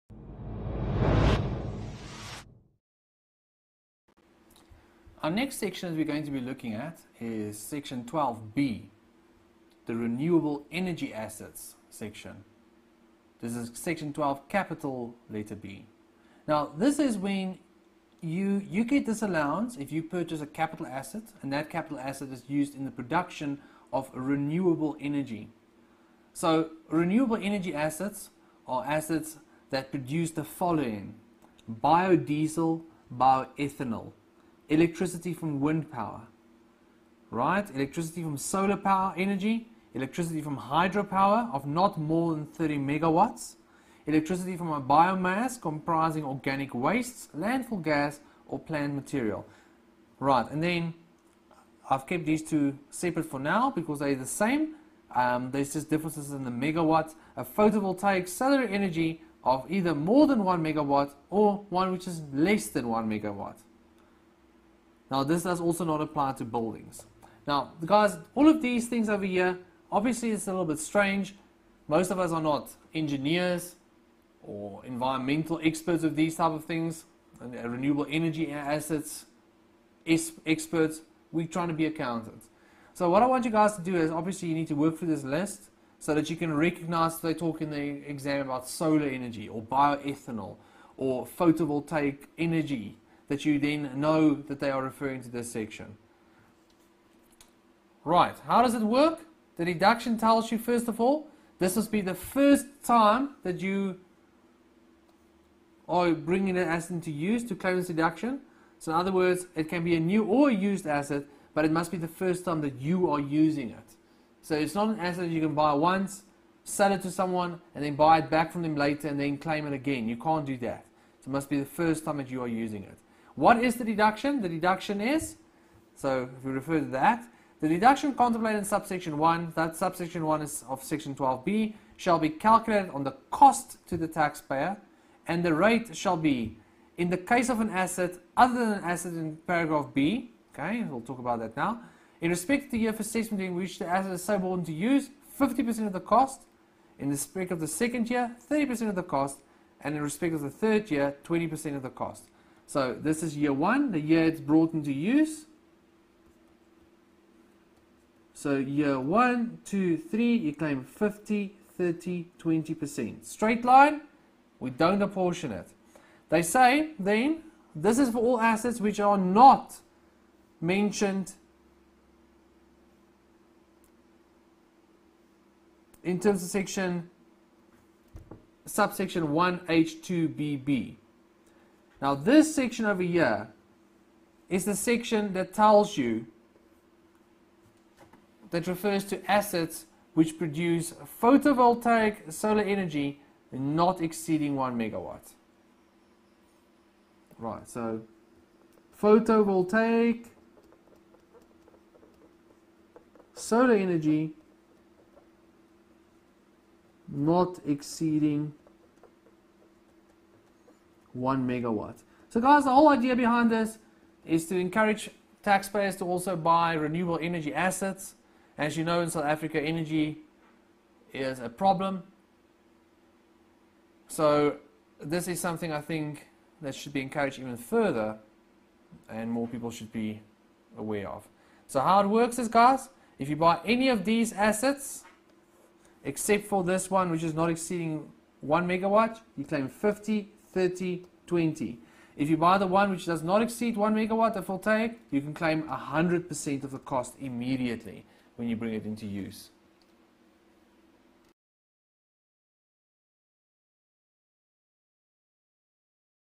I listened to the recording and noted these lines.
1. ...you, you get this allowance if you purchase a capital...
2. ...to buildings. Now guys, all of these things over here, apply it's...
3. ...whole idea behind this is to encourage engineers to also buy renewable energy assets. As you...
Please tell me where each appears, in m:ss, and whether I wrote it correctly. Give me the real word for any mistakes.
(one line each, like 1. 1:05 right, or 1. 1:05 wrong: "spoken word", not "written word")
1. 0:18 right
2. 1:06 wrong: "obviously", not "apply"
3. 3:32 wrong: "taxpayers", not "engineers".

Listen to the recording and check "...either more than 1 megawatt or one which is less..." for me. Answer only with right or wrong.
right.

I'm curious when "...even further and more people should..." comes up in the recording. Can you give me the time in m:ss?
3:47.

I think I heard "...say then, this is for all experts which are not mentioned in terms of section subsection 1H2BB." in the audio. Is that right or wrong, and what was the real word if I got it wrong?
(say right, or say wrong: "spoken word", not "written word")
wrong: "assets", not "experts".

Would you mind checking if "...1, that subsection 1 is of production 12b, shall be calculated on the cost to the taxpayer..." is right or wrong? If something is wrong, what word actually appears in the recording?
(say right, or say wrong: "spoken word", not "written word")
wrong: "section", not "production".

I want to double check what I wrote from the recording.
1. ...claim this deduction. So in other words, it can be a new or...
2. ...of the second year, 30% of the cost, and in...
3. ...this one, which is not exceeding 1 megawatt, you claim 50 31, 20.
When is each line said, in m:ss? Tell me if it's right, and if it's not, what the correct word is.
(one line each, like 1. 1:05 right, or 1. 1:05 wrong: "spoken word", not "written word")
1. 1:47 right
2. 2:27 right
3. 3:56 wrong: "30", not "31".